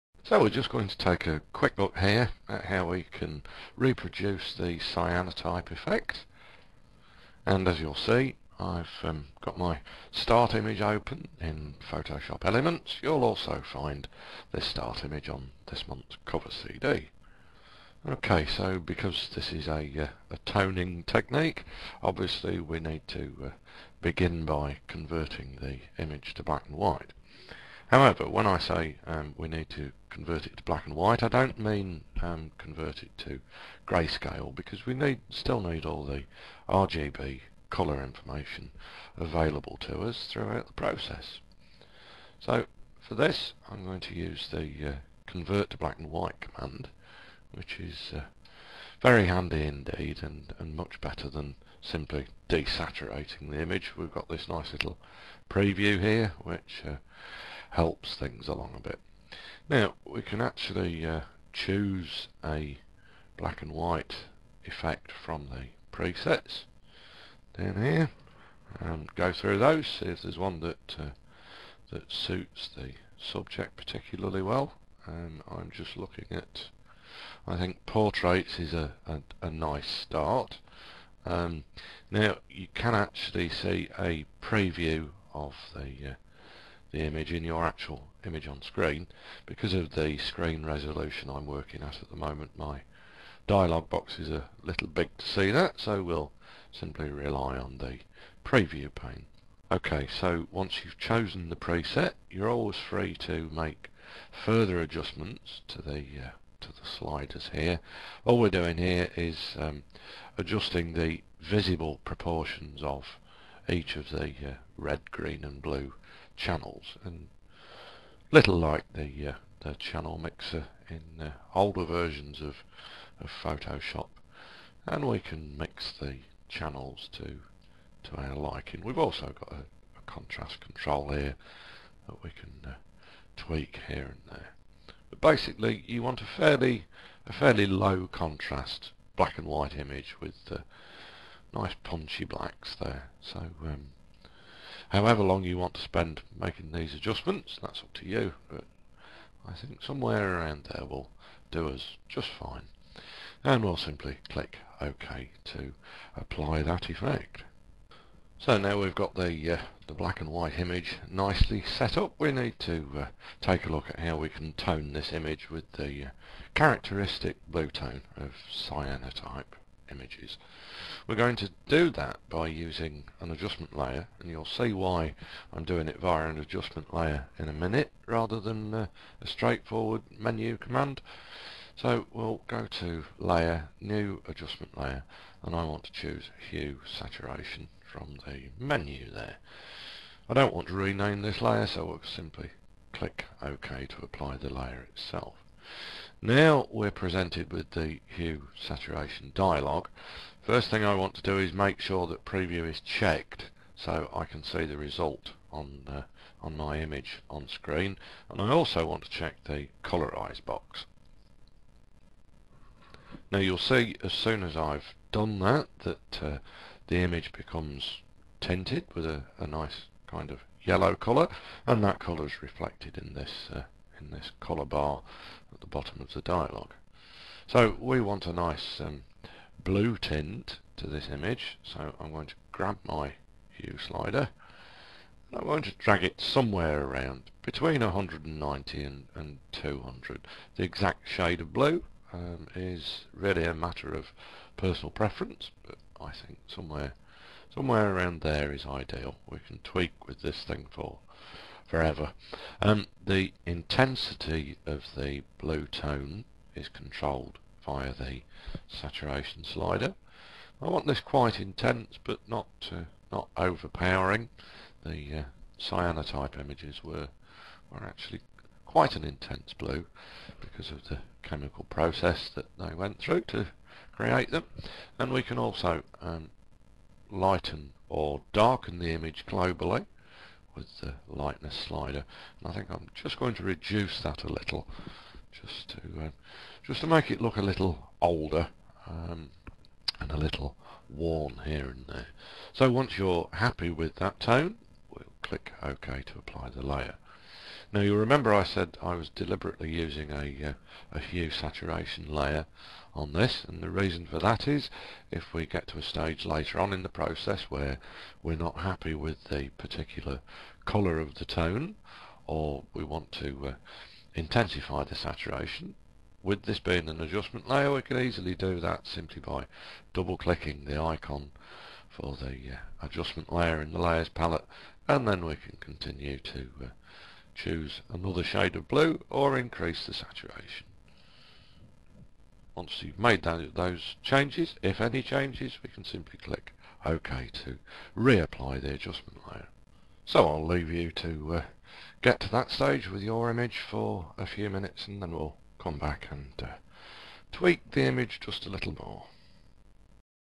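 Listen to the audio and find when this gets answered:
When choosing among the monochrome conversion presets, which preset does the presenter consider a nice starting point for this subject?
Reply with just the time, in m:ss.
1:17.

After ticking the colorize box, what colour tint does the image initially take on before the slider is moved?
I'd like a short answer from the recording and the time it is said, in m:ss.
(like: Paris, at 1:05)
Yellow, at 3:40.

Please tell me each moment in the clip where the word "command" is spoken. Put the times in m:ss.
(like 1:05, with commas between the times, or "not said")
0:46, 3:00.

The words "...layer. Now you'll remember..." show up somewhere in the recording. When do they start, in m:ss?
4:56.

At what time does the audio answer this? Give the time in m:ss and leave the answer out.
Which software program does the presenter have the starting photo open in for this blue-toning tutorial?
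0:11.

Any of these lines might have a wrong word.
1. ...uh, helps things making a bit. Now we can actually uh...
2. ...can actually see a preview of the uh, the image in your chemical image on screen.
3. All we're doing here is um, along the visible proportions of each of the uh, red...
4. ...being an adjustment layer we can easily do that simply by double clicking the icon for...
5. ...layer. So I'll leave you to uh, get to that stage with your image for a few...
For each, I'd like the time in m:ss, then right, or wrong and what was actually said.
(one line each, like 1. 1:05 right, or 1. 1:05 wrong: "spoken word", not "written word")
1. 0:56 wrong: "along", not "making"
2. 1:22 wrong: "actual", not "chemical"
3. 1:48 wrong: "adjusting", not "along"
4. 5:16 right
5. 5:39 right.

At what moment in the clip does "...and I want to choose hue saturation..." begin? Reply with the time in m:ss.
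3:05.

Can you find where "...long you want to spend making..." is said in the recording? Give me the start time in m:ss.
2:25.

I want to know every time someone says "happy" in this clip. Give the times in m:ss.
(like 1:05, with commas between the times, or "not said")
4:53, 5:08.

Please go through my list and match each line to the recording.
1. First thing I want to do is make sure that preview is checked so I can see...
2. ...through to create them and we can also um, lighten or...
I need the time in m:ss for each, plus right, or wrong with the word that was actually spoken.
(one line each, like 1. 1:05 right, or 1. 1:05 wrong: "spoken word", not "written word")
1. 3:20 right
2. 4:32 right.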